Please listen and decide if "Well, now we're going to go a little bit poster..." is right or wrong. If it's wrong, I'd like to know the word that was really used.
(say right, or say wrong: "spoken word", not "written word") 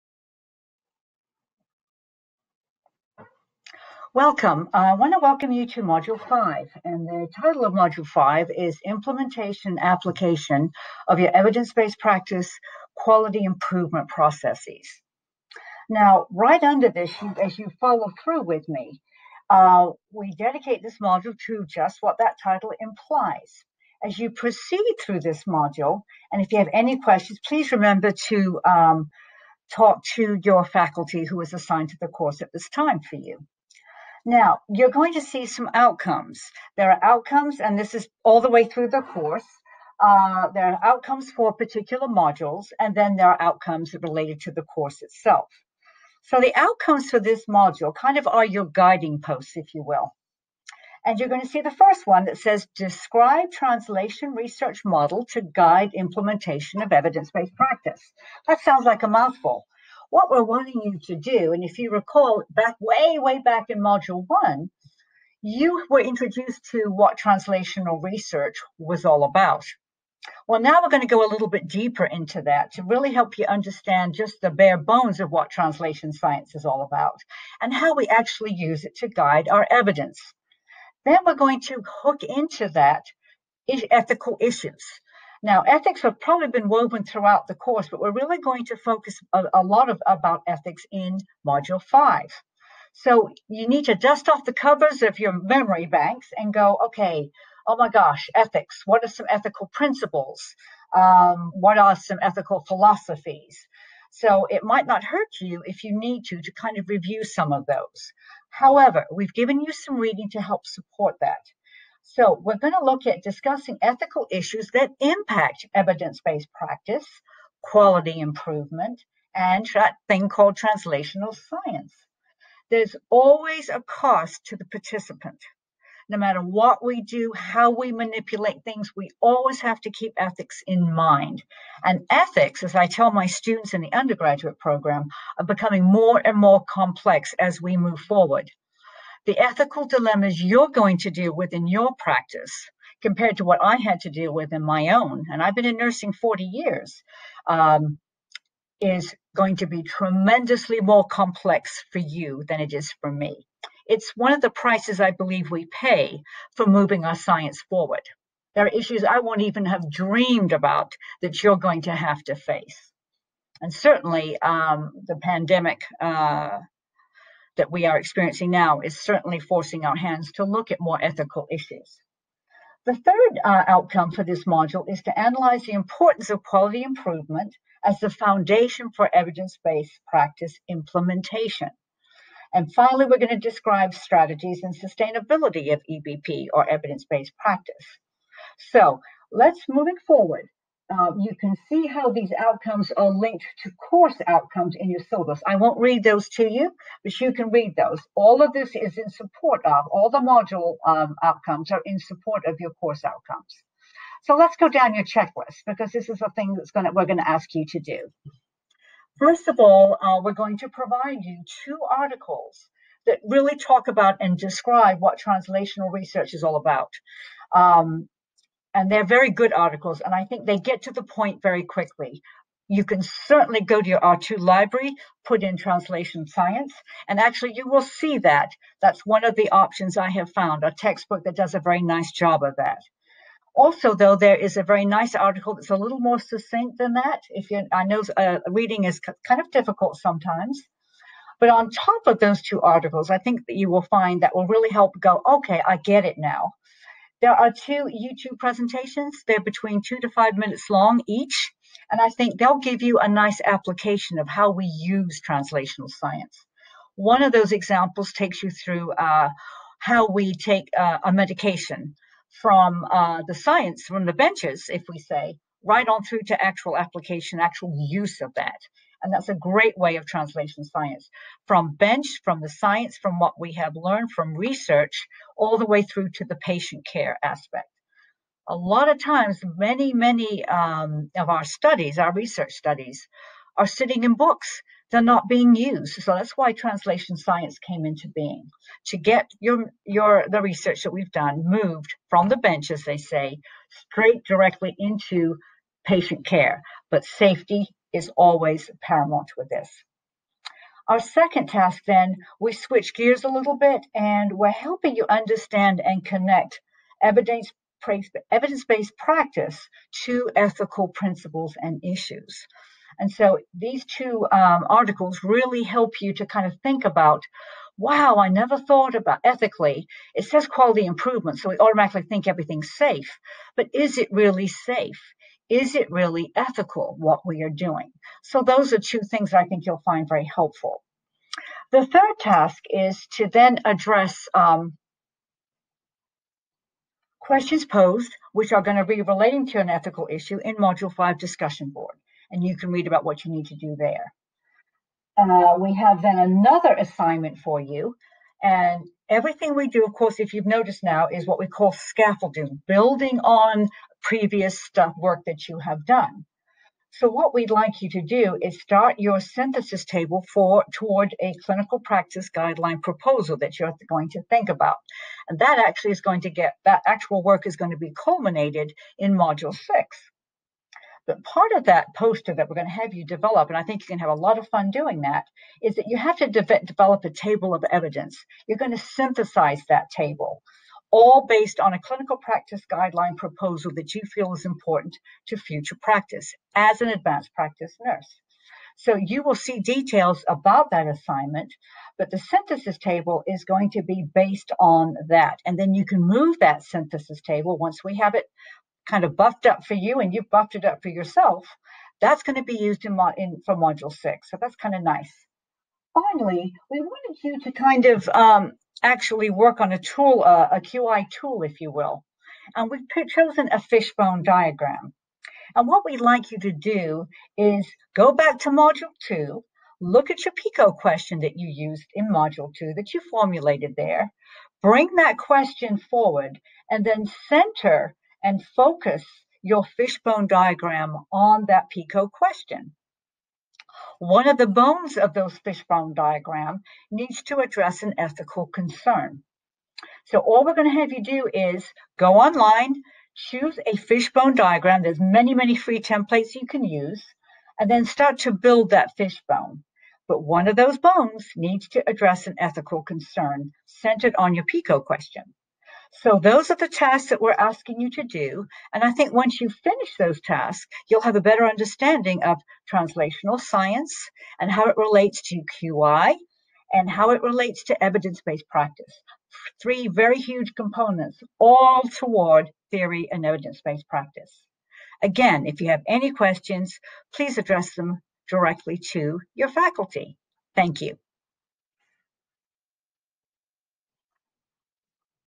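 wrong: "deeper", not "poster".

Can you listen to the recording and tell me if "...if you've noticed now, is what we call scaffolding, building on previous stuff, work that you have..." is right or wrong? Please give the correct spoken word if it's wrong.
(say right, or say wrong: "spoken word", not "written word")
right.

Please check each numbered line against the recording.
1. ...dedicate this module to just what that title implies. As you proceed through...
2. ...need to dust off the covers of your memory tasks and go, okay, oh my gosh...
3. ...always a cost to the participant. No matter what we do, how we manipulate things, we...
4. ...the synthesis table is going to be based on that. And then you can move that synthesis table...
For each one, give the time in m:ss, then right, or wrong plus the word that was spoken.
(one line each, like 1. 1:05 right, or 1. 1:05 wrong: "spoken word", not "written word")
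1. 0:20 right
2. 1:33 wrong: "banks", not "tasks"
3. 2:03 right
4. 6:32 right.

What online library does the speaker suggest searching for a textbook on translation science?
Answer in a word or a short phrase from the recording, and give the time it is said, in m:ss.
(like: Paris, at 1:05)
R2 library, at 3:43.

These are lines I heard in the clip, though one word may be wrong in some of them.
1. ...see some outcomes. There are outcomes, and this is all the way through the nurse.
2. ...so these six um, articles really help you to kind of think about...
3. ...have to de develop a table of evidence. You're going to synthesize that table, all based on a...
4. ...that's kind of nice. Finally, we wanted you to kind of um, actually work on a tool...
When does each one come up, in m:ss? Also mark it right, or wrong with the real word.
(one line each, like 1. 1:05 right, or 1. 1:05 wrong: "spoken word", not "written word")
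1. 0:35 wrong: "course", not "nurse"
2. 5:13 wrong: "two", not "six"
3. 6:15 right
4. 6:44 right.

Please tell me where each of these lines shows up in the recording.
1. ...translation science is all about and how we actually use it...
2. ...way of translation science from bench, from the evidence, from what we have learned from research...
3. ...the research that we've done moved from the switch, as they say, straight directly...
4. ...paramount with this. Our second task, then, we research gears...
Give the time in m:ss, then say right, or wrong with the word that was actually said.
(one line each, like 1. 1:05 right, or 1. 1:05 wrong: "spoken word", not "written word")
1. 1:15 right
2. 4:29 wrong: "science", not "evidence"
3. 4:50 wrong: "bench", not "switch"
4. 4:58 wrong: "switch", not "research".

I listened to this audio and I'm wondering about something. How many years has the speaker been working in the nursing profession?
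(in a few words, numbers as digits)
40 years.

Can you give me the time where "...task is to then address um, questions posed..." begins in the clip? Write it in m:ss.
5:32.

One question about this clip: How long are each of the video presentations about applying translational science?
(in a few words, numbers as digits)
2 to 5 minutes.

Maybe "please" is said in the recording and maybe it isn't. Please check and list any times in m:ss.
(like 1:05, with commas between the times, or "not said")
0:27, 7:57.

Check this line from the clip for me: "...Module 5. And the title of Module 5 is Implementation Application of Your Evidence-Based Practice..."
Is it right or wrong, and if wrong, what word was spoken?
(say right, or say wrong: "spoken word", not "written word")
right.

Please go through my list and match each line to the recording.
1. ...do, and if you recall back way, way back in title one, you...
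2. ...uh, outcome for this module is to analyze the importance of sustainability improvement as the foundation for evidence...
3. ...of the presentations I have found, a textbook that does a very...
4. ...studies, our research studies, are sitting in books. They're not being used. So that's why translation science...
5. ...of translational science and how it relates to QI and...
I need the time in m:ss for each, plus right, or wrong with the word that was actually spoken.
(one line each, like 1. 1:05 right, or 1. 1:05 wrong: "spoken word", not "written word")
1. 1:01 wrong: "module", not "title"
2. 2:53 wrong: "quality", not "sustainability"
3. 3:49 wrong: "options", not "presentations"
4. 4:41 right
5. 7:42 right.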